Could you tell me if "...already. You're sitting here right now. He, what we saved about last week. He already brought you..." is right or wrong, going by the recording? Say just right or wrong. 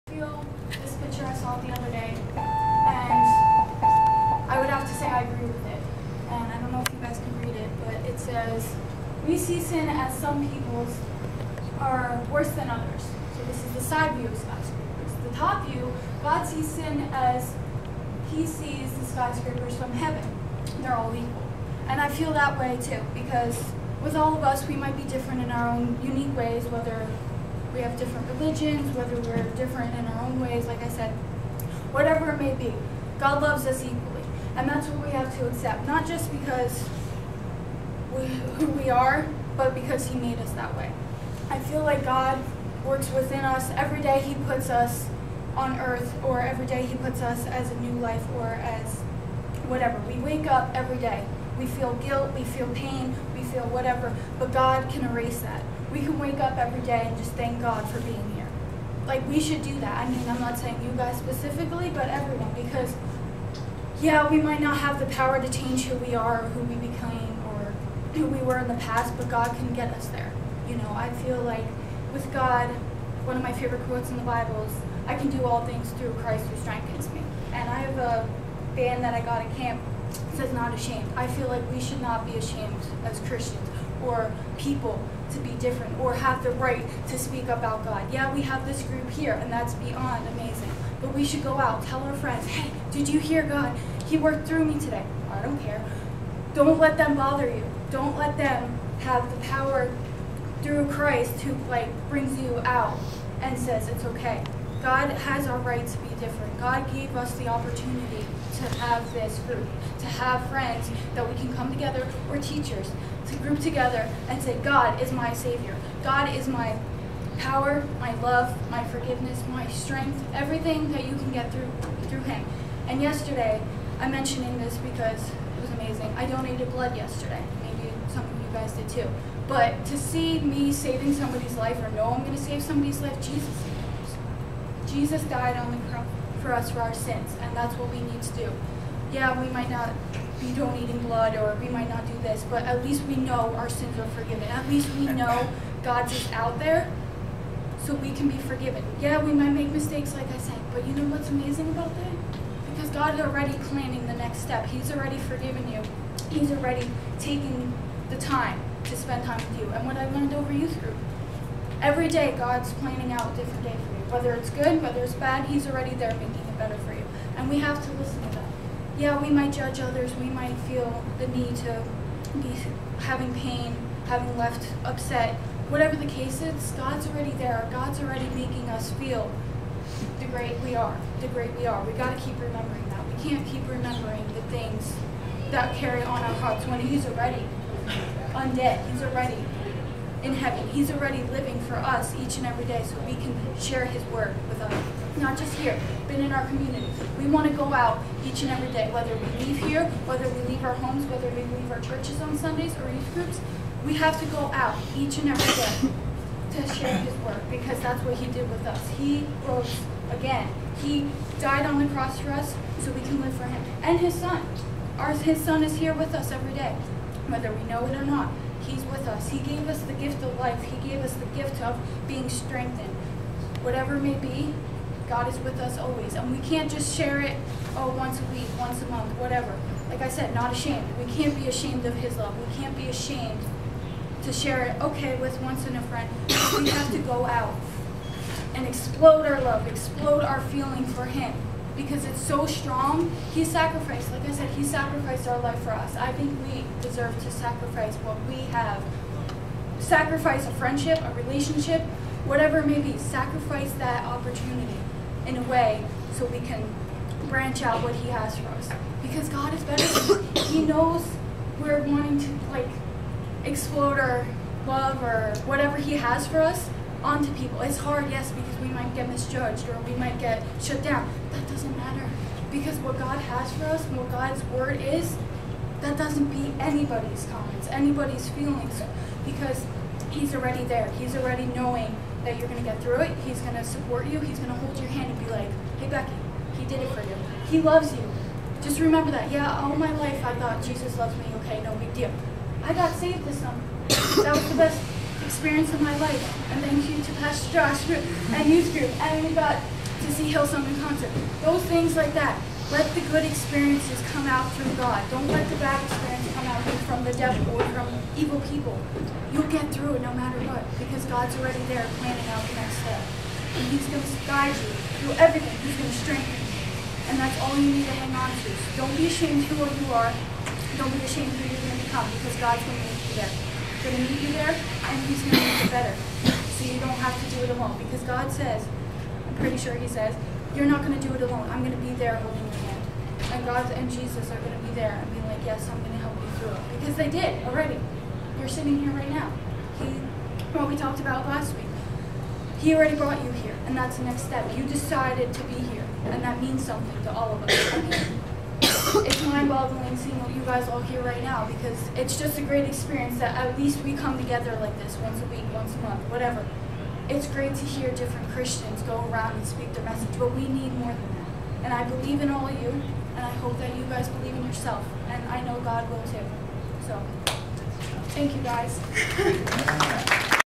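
wrong.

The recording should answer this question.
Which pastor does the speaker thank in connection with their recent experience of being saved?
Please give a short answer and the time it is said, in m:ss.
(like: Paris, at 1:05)
Pastor Josh, at 4:57.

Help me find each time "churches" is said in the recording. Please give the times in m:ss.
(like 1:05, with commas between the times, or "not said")
3:21.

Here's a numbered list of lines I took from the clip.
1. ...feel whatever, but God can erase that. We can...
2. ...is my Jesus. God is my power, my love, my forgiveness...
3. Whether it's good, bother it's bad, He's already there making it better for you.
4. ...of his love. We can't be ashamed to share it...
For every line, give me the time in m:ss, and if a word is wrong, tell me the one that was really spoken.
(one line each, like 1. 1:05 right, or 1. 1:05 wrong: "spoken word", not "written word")
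1. 0:53 right
2. 1:55 wrong: "Savior", not "Jesus"
3. 2:44 wrong: "whether", not "bother"
4. 3:51 right.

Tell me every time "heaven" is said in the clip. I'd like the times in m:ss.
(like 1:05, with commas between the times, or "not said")
0:19, 3:10.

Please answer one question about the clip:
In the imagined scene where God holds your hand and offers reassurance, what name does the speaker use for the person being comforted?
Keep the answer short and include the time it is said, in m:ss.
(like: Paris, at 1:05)
Becky, at 4:45.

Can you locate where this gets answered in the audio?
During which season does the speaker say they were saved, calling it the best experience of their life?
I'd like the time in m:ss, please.
4:53.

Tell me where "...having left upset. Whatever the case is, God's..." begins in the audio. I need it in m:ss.
2:54.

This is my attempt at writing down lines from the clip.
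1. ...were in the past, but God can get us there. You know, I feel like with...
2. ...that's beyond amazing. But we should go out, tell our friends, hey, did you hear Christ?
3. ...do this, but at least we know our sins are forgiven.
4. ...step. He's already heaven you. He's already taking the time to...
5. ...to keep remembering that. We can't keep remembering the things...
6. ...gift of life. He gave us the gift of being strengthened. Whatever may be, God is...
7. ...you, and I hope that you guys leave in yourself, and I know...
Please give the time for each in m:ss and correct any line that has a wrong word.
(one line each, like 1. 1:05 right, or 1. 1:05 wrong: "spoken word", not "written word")
1. 1:08 right
2. 1:29 wrong: "God", not "Christ"
3. 2:22 right
4. 2:34 wrong: "forgiven", not "heaven"
5. 3:02 right
6. 3:39 right
7. 6:02 wrong: "believe", not "leave".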